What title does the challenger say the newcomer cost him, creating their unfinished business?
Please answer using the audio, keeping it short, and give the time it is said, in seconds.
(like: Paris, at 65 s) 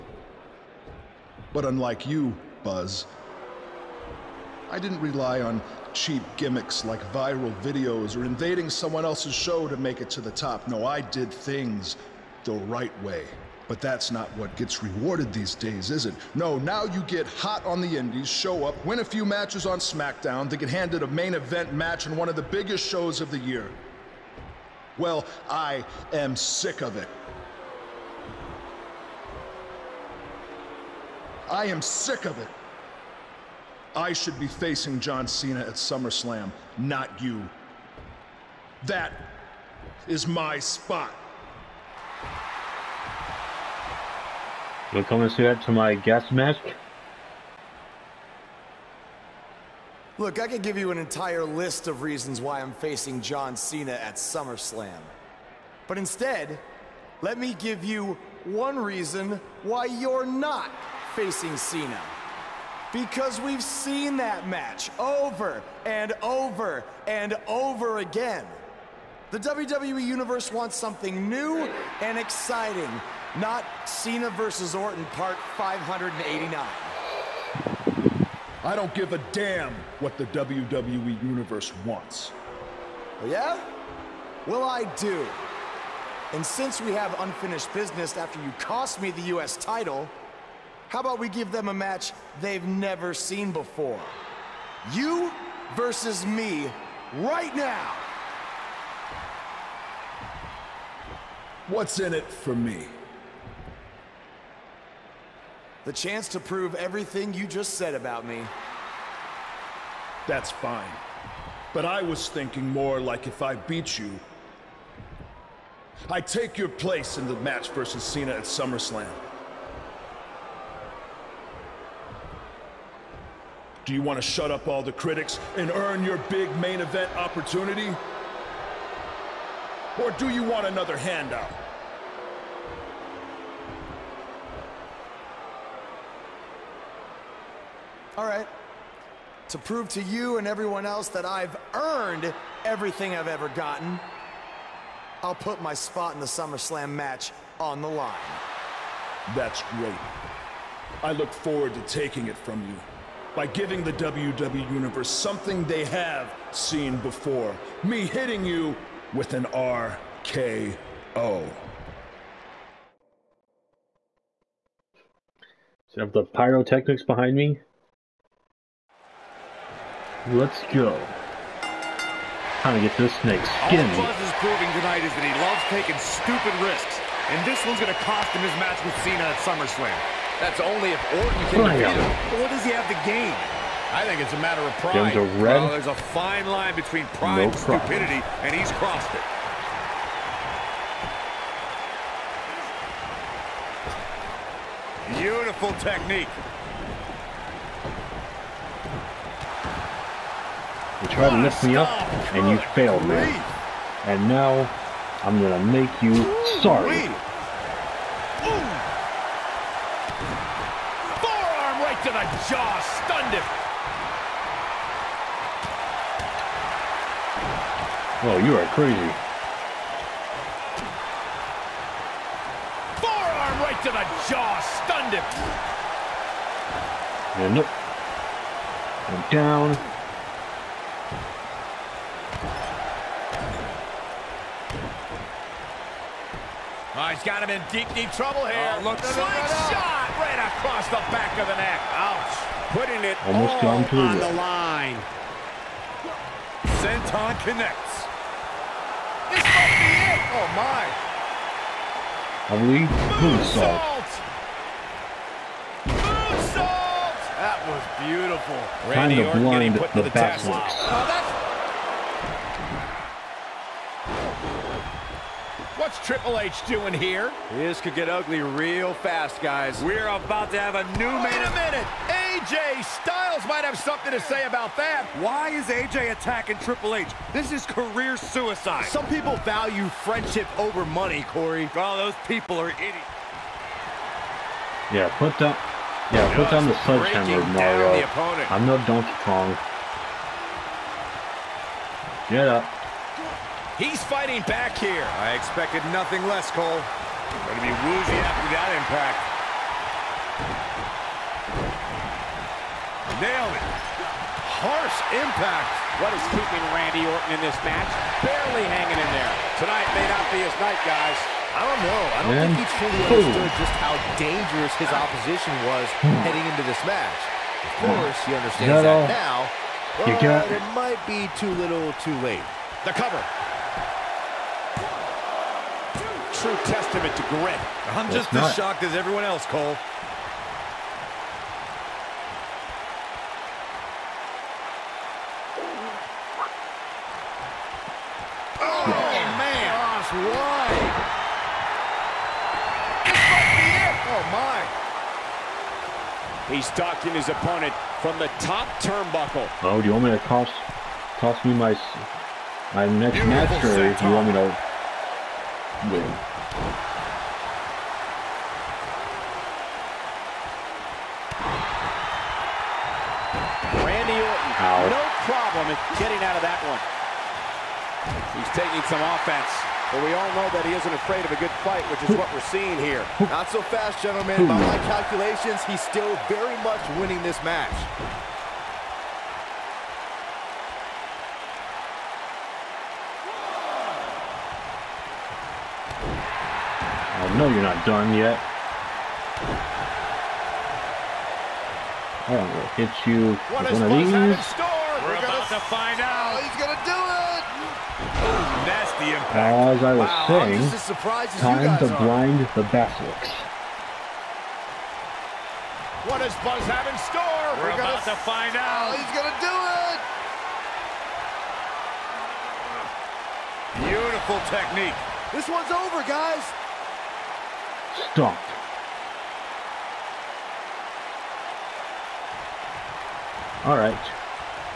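U.S. title, at 89 s.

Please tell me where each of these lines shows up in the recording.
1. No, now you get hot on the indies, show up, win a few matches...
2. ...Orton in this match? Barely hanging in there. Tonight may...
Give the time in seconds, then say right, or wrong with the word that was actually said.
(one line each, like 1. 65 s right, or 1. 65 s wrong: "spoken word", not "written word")
1. 16 s right
2. 307 s right.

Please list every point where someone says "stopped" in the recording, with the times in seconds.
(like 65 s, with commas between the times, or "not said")
418 s.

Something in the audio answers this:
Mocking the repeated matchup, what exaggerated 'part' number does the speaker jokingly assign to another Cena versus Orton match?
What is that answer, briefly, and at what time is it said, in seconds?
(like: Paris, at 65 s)
589, at 75 s.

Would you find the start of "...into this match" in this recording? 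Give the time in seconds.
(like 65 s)
316 s.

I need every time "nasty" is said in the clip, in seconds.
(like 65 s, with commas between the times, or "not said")
398 s.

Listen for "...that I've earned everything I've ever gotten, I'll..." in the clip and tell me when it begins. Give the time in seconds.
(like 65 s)
141 s.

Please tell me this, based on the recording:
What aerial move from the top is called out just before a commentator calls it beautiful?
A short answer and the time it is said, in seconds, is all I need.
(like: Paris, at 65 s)
Moonsault, at 255 s.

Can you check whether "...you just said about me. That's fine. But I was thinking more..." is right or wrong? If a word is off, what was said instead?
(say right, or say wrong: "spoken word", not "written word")
right.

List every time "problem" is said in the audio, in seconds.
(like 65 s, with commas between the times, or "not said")
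188 s, 365 s.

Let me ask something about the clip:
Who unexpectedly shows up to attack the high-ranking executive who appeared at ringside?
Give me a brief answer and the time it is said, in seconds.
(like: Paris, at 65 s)
AJ Styles, at 272 s.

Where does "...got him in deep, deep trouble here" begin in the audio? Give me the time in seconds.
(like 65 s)
237 s.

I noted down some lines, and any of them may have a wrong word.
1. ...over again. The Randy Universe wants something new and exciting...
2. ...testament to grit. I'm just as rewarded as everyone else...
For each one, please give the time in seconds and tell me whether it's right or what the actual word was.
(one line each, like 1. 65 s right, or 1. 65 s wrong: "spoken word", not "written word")
1. 67 s wrong: "WWE", not "Randy"
2. 326 s wrong: "shocked", not "rewarded".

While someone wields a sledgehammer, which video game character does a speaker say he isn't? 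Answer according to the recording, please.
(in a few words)
Donkey Kong.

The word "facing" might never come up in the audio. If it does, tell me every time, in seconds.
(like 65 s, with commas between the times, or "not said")
34 s, 52 s, 61 s.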